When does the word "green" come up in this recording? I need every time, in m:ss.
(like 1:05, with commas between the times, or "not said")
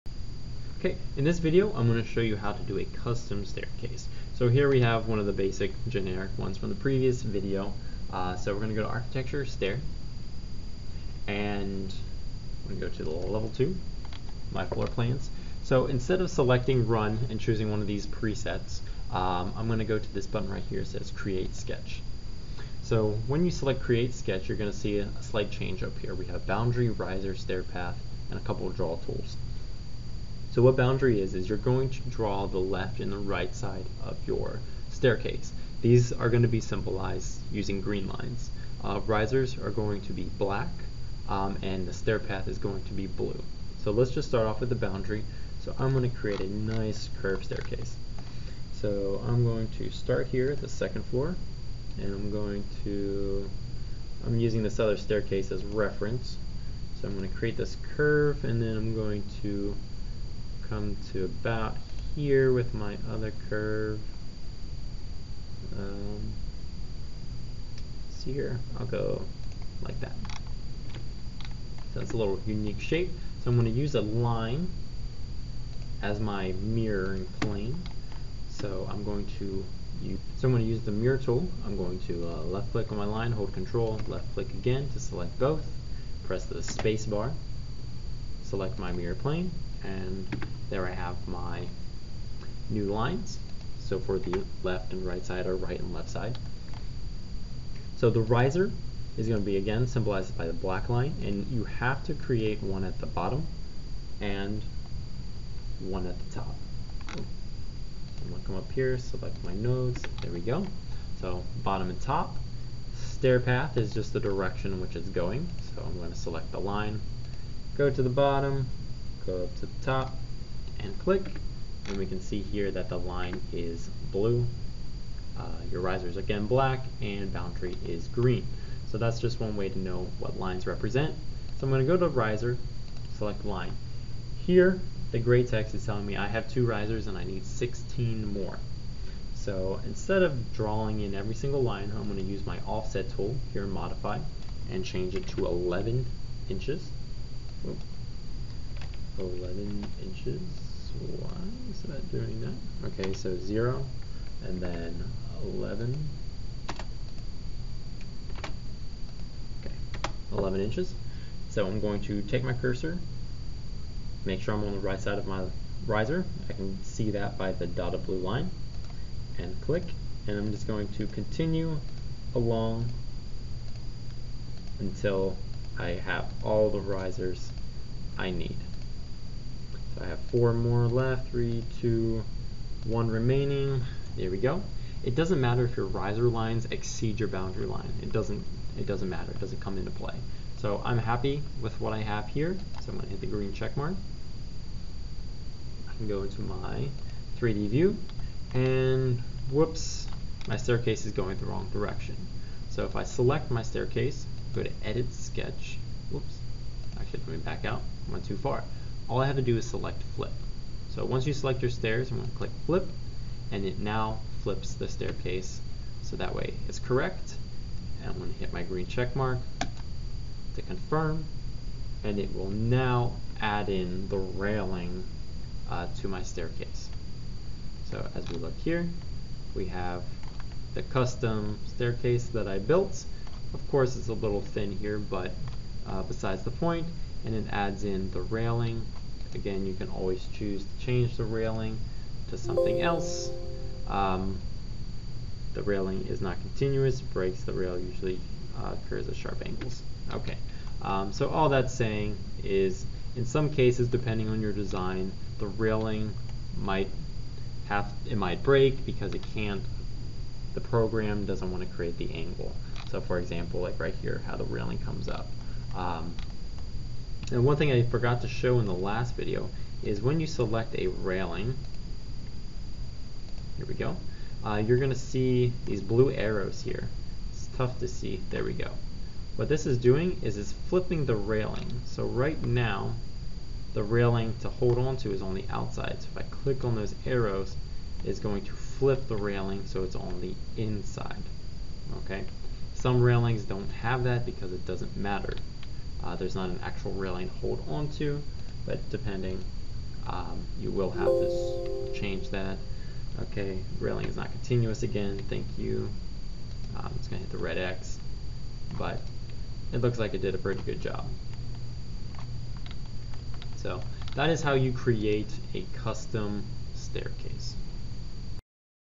0:37, 2:08, 3:13, 3:38.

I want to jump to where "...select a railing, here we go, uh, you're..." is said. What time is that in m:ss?
4:30.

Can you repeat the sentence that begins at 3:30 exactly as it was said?
So once you select your stairs, I'm going to click flip, and it now flips the staircase.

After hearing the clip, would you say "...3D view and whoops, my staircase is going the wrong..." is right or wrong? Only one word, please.
right.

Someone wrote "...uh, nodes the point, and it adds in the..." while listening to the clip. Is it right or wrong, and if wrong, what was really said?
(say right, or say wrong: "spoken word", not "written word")
wrong: "besides", not "nodes".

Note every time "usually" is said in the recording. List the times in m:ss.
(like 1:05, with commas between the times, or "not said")
4:07.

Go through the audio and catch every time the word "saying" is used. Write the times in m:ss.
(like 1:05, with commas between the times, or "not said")
4:11.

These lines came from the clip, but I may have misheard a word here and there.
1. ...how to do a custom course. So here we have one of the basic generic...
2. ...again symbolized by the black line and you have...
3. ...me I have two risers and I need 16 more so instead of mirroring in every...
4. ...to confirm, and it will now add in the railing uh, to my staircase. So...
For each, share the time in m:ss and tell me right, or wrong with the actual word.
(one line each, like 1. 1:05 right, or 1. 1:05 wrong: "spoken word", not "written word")
1. 0:02 wrong: "staircase", not "course"
2. 1:39 right
3. 2:16 wrong: "drawing", not "mirroring"
4. 3:40 right.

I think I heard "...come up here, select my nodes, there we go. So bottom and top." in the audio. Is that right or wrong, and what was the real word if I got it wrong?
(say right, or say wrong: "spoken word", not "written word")
right.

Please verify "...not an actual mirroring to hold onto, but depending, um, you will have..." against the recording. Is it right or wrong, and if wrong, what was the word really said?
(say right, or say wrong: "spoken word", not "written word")
wrong: "railing", not "mirroring".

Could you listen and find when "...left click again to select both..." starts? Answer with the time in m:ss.
1:24.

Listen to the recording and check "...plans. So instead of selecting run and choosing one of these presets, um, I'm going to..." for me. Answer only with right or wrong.
right.